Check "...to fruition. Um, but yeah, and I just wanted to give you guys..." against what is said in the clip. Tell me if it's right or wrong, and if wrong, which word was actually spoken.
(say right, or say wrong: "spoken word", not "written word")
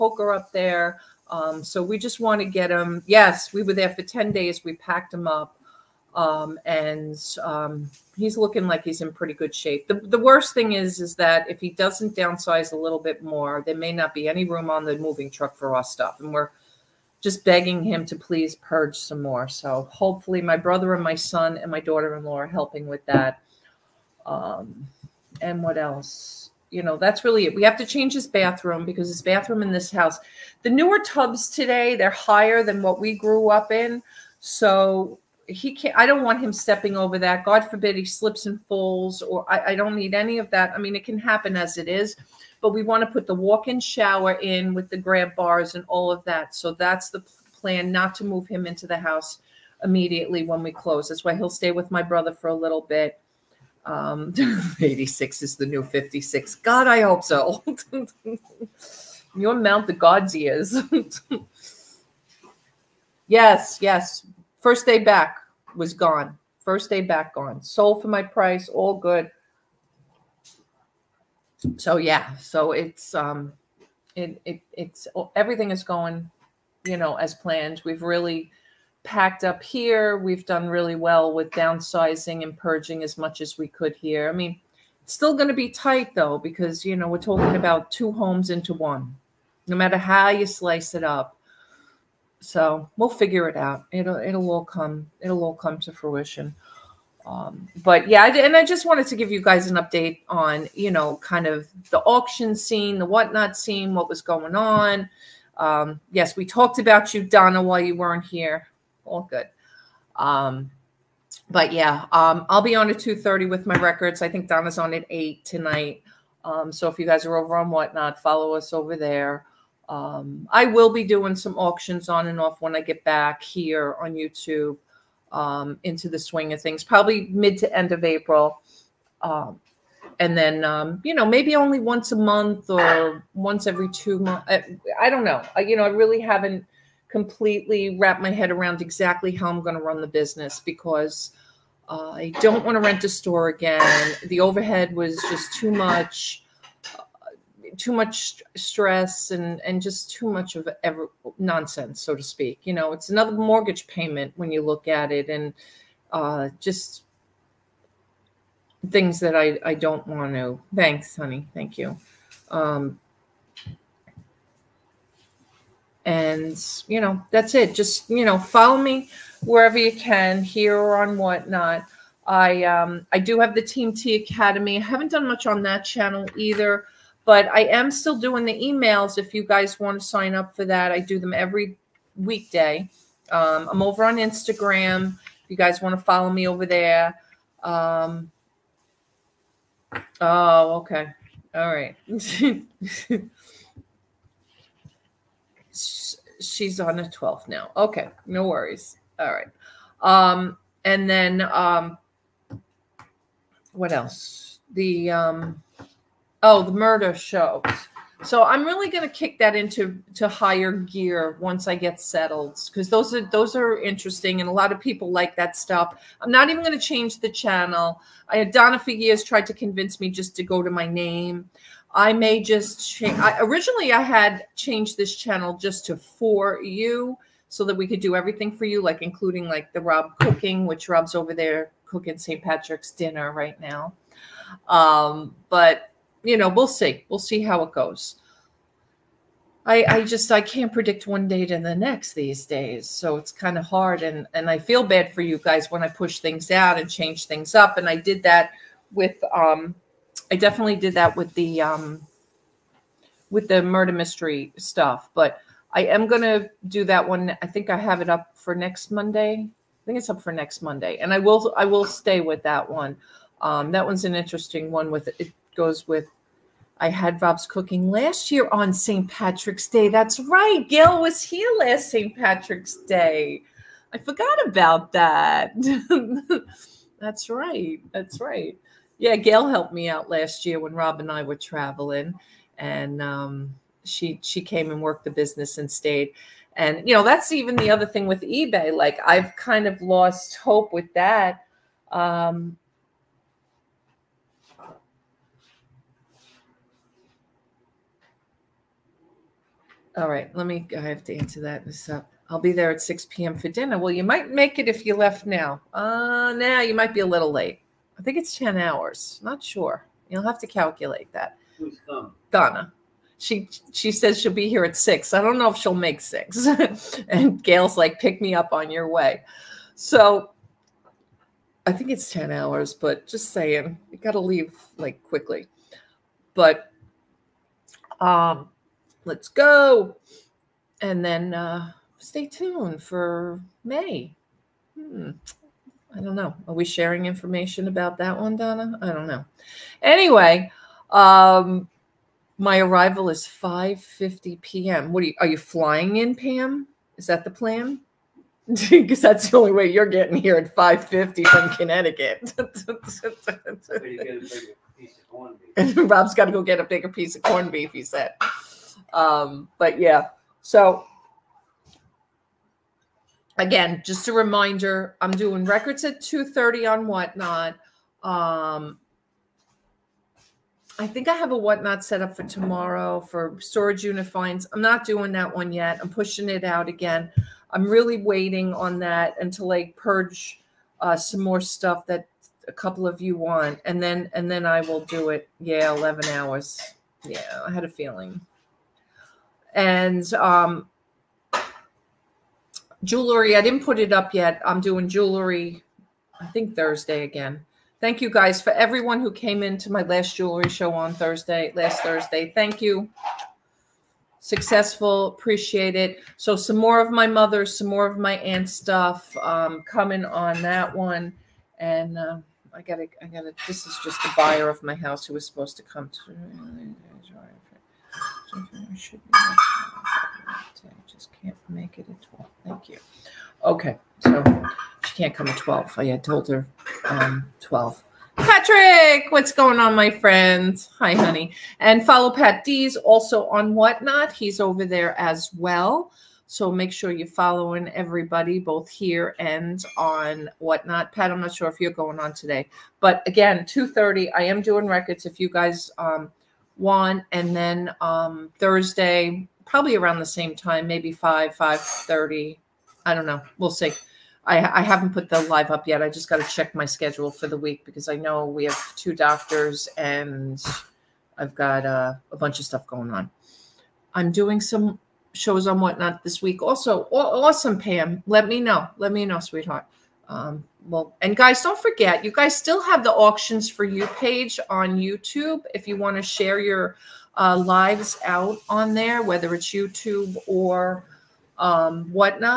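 right.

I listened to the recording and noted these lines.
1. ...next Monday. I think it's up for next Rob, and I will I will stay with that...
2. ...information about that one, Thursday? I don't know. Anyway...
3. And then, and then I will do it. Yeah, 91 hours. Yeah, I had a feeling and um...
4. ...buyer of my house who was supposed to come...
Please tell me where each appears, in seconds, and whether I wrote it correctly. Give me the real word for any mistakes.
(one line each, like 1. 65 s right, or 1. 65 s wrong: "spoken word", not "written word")
1. 258 s wrong: "Monday", not "Rob"
2. 337 s wrong: "Donna", not "Thursday"
3. 383 s wrong: "11", not "91"
4. 414 s right.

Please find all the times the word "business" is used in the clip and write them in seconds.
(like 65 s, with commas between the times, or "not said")
140 s, 285 s.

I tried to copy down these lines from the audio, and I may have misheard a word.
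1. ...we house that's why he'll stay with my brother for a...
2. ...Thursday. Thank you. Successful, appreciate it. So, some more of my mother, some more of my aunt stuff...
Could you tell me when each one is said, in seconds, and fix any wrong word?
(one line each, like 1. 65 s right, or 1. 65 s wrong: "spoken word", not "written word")
1. 50 s wrong: "close", not "house"
2. 401 s right.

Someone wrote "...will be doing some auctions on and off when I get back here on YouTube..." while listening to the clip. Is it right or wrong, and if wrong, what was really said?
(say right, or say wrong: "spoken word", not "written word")
right.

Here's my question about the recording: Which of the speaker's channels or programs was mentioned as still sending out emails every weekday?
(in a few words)
Team Tee Academy.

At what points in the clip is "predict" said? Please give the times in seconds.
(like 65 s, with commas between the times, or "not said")
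240 s.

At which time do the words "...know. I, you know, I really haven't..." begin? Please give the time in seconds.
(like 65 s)
135 s.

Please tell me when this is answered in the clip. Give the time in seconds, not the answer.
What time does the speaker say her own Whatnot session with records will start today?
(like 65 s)
112 s.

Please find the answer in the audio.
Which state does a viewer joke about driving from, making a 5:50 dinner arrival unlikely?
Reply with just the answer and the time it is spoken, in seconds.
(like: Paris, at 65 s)
Connecticut, at 351 s.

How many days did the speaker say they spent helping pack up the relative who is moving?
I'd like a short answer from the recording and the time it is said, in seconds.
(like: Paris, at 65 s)
10, at 4 s.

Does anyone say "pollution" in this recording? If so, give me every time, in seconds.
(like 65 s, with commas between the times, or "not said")
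not said.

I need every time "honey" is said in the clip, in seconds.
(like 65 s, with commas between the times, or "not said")
161 s, 430 s.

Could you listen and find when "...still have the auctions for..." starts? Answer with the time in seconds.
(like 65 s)
472 s.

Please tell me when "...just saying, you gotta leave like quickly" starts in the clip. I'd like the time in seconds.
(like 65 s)
323 s.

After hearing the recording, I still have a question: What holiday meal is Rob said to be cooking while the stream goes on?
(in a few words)
St. Patrick's dinner.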